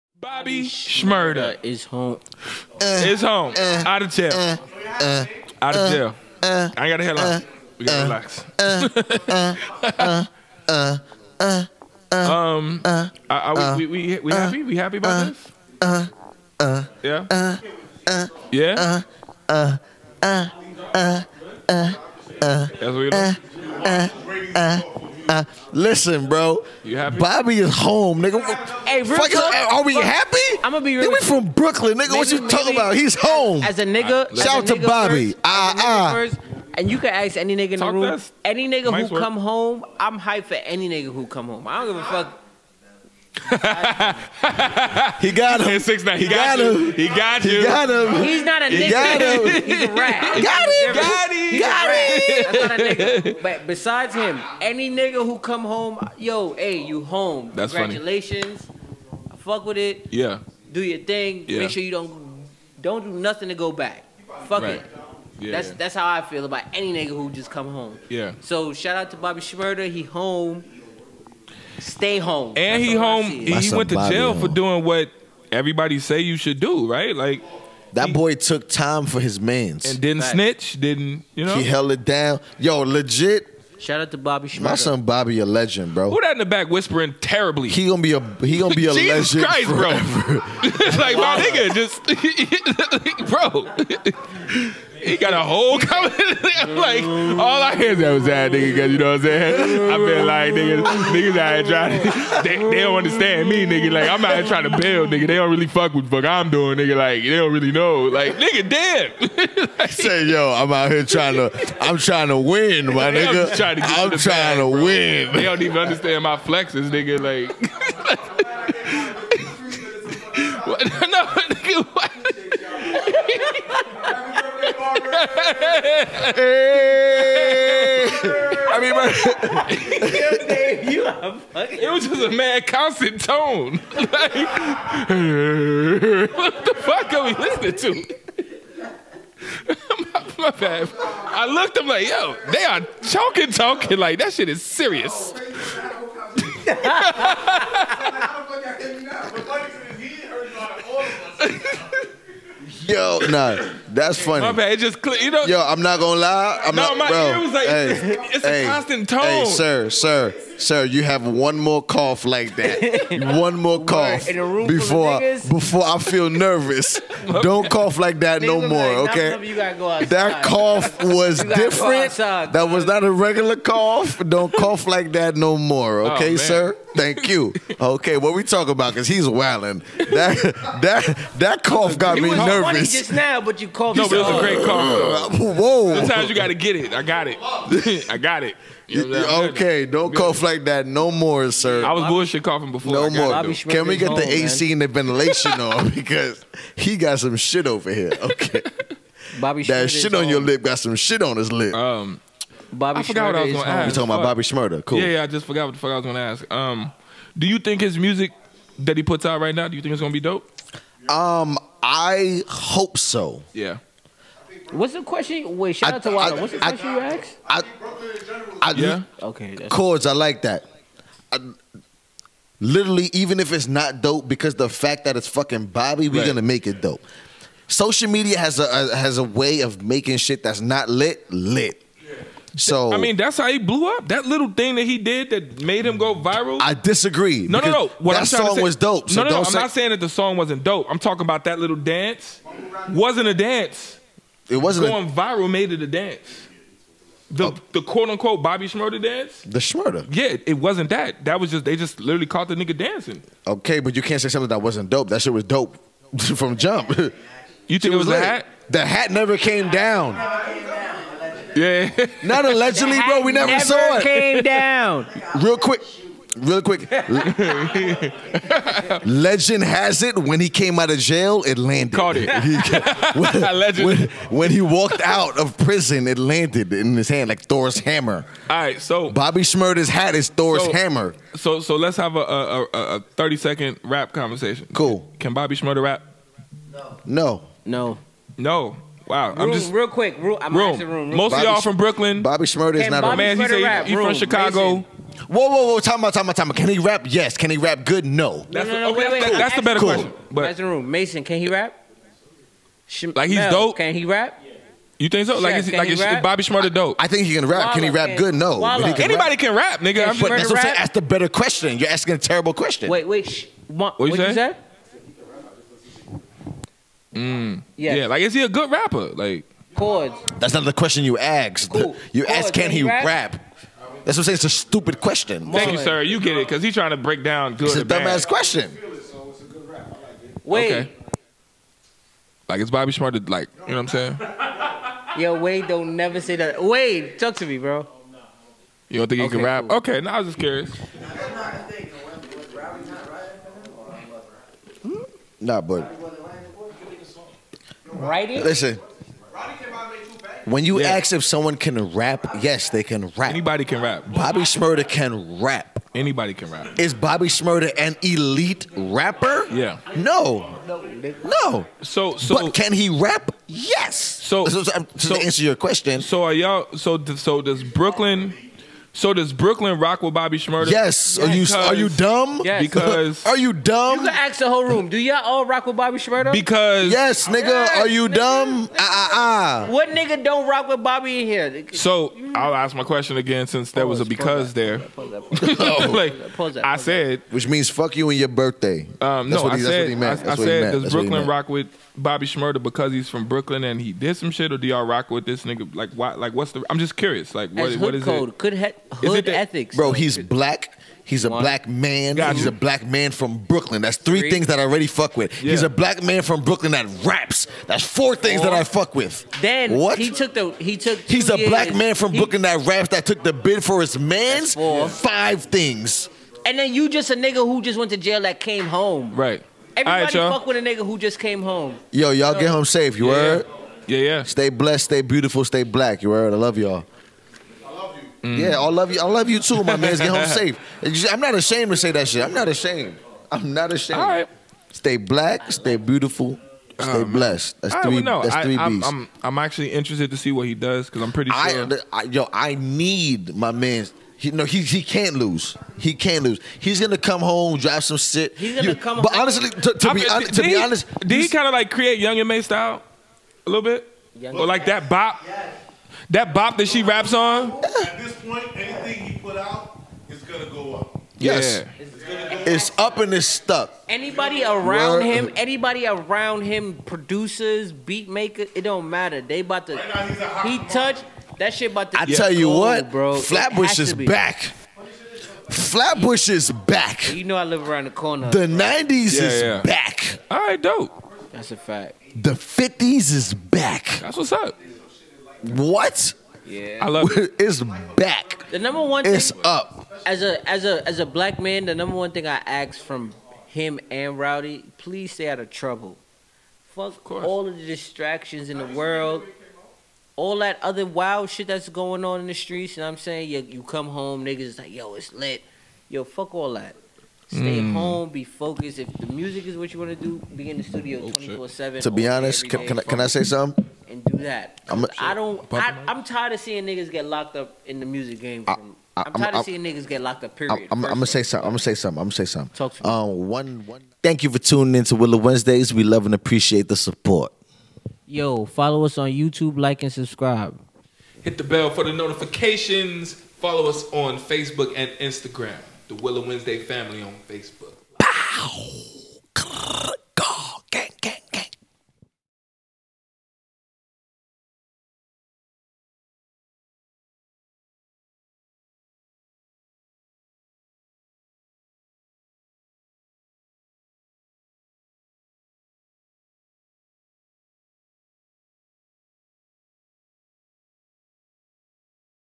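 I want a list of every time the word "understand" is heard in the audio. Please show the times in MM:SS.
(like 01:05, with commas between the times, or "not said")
01:42, 01:55.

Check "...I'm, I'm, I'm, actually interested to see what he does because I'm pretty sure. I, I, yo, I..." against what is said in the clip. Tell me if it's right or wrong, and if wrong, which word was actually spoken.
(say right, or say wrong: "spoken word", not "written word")
right.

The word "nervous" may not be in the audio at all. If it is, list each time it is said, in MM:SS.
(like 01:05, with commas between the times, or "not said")
02:46, 03:02.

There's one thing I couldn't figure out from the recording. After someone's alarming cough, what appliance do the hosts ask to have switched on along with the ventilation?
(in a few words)
AC.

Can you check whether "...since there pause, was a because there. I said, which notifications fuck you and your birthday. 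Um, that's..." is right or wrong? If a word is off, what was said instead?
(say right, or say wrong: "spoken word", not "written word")
wrong: "means", not "notifications".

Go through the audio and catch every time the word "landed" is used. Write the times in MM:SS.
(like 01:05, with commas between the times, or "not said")
04:31, 04:36.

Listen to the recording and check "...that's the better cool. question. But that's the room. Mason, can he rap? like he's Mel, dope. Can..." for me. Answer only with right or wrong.
right.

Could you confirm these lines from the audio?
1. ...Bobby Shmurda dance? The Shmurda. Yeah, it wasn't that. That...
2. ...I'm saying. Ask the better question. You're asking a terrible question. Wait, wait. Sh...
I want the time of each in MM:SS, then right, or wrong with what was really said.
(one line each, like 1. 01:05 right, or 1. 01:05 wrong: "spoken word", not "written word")
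1. 04:08 right
2. 05:10 right.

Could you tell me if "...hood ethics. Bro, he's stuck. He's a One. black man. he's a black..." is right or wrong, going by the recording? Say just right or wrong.
wrong.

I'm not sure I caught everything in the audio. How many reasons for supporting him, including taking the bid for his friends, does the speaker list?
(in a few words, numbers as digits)
5.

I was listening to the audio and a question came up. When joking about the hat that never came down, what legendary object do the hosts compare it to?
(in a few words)
Thor's hammer.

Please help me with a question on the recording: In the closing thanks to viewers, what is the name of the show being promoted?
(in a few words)
Willa Wednesdays.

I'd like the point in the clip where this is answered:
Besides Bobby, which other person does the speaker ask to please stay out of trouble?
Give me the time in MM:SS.
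08:14.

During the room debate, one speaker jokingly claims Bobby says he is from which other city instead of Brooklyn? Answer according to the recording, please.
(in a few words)
Chicago.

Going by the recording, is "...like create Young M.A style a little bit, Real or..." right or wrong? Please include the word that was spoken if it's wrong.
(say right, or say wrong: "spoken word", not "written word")
wrong: "Young", not "Real".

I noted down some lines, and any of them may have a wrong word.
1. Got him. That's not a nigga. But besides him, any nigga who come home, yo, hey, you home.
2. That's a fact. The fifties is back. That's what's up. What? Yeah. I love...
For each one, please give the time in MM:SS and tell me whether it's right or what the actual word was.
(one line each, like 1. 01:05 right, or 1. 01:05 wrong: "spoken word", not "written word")
1. 00:51 right
2. 08:01 right.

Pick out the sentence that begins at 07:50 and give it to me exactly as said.
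he touched that shit about to.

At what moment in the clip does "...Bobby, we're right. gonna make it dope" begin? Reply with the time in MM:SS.
03:45.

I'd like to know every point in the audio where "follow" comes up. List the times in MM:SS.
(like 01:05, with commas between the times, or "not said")
08:48, 08:53.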